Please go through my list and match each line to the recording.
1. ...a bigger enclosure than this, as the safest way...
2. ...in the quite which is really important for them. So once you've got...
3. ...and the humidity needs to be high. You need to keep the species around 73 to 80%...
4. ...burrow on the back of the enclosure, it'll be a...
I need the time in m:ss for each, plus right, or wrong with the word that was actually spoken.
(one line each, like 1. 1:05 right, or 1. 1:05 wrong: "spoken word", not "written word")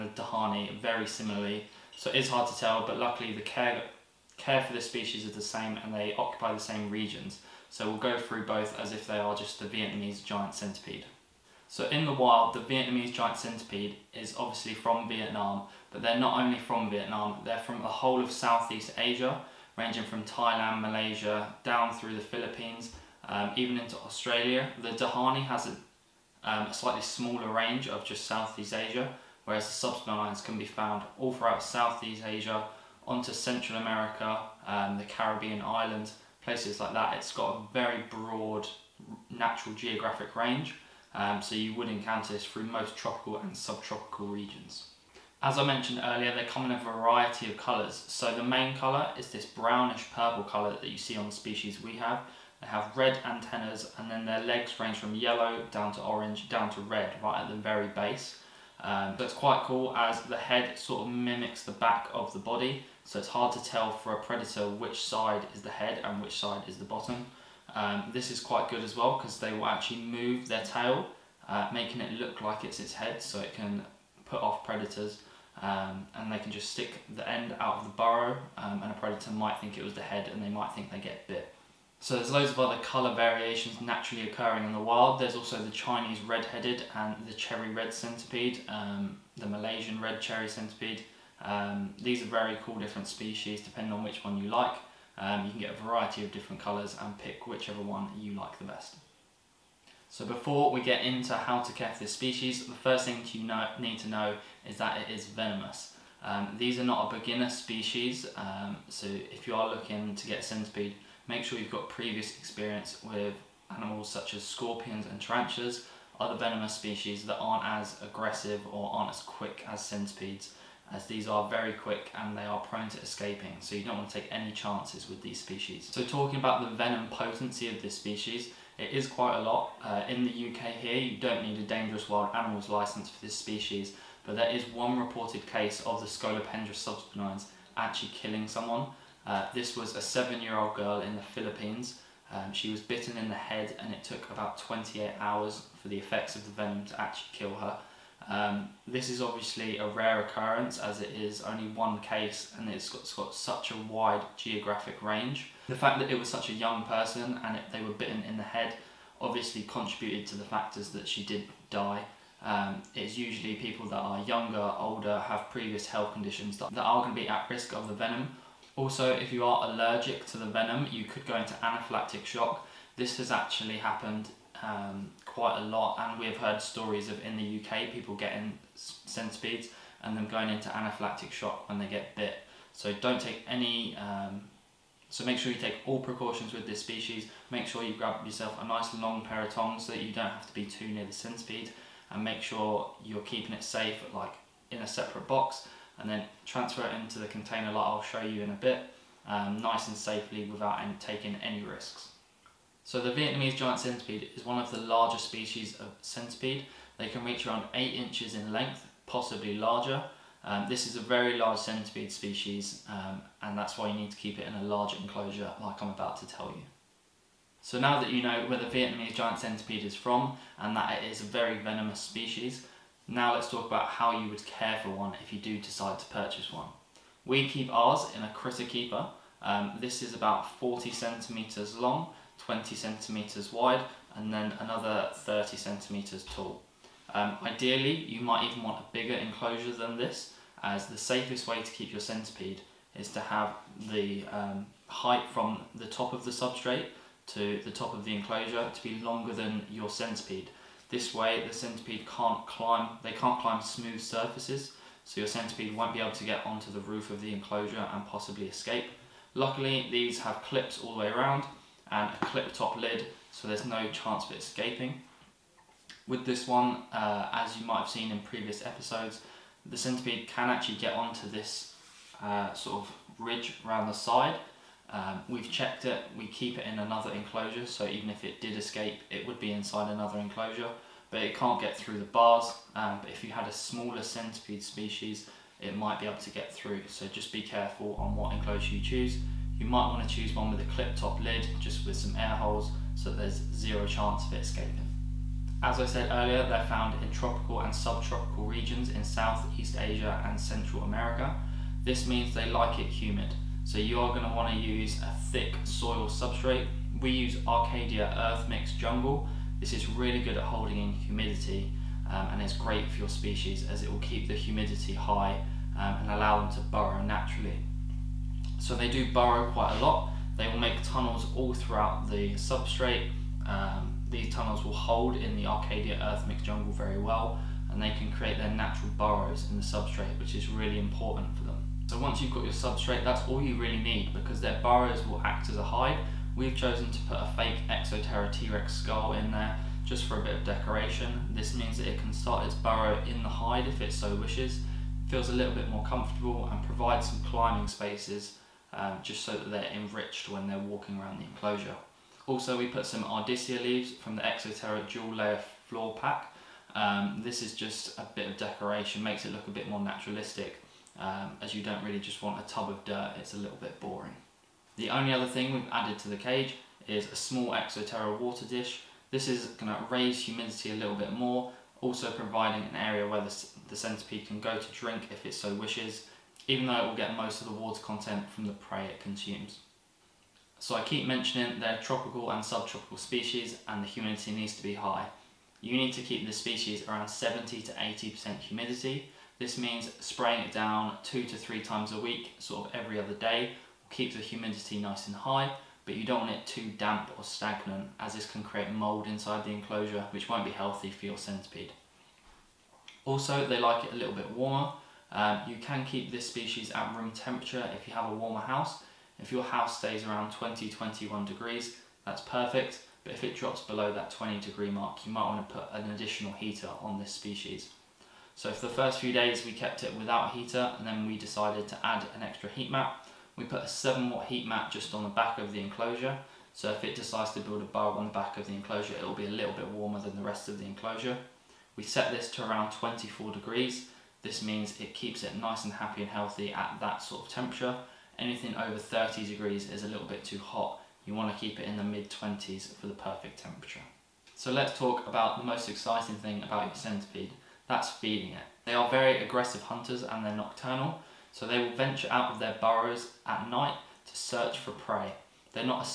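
1. 3:58 right
2. 5:29 wrong: "substrate", not "quite"
3. 6:23 wrong: "70", not "73"
4. 7:07 right.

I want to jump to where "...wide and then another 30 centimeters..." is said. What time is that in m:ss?
3:53.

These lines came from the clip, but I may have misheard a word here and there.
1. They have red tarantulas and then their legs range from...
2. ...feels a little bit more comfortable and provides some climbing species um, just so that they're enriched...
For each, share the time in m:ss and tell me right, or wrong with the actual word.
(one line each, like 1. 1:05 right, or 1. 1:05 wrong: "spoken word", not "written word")
1. 0:52 wrong: "antennas", not "tarantulas"
2. 5:45 wrong: "spaces", not "species".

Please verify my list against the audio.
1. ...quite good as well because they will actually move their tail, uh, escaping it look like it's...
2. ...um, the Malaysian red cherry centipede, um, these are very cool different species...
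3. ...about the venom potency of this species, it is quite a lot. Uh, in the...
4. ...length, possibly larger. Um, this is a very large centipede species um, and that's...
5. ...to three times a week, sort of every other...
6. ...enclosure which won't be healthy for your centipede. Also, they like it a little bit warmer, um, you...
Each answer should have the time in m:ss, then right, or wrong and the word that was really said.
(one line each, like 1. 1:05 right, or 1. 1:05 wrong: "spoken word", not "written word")
1. 1:08 wrong: "making", not "escaping"
2. 1:28 right
3. 2:06 right
4. 3:28 right
5. 6:31 right
6. 6:39 right.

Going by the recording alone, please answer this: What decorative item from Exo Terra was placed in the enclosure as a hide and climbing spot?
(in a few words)
T-Rex skull.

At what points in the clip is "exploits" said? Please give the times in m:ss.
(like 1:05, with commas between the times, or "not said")
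not said.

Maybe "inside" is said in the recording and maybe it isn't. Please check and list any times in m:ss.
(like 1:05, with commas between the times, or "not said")
4:39, 6:39.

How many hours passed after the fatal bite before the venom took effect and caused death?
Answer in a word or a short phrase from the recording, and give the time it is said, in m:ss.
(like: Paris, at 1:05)
28, at 2:24.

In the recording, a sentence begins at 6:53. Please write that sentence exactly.
But if it drops below that 20 degree mark, you might want to put an additional heater on this species.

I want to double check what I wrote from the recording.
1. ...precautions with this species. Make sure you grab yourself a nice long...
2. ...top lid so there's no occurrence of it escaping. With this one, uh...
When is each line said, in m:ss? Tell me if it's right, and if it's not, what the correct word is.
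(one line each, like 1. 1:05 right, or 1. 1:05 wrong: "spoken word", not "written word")
1. 3:05 right
2. 4:22 wrong: "chance", not "occurrence".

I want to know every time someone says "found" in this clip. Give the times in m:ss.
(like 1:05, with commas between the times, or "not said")
0:30, 4:56.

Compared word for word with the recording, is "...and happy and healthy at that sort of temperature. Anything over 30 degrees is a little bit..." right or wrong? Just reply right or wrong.
right.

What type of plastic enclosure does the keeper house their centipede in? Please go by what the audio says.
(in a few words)
Critter keeper.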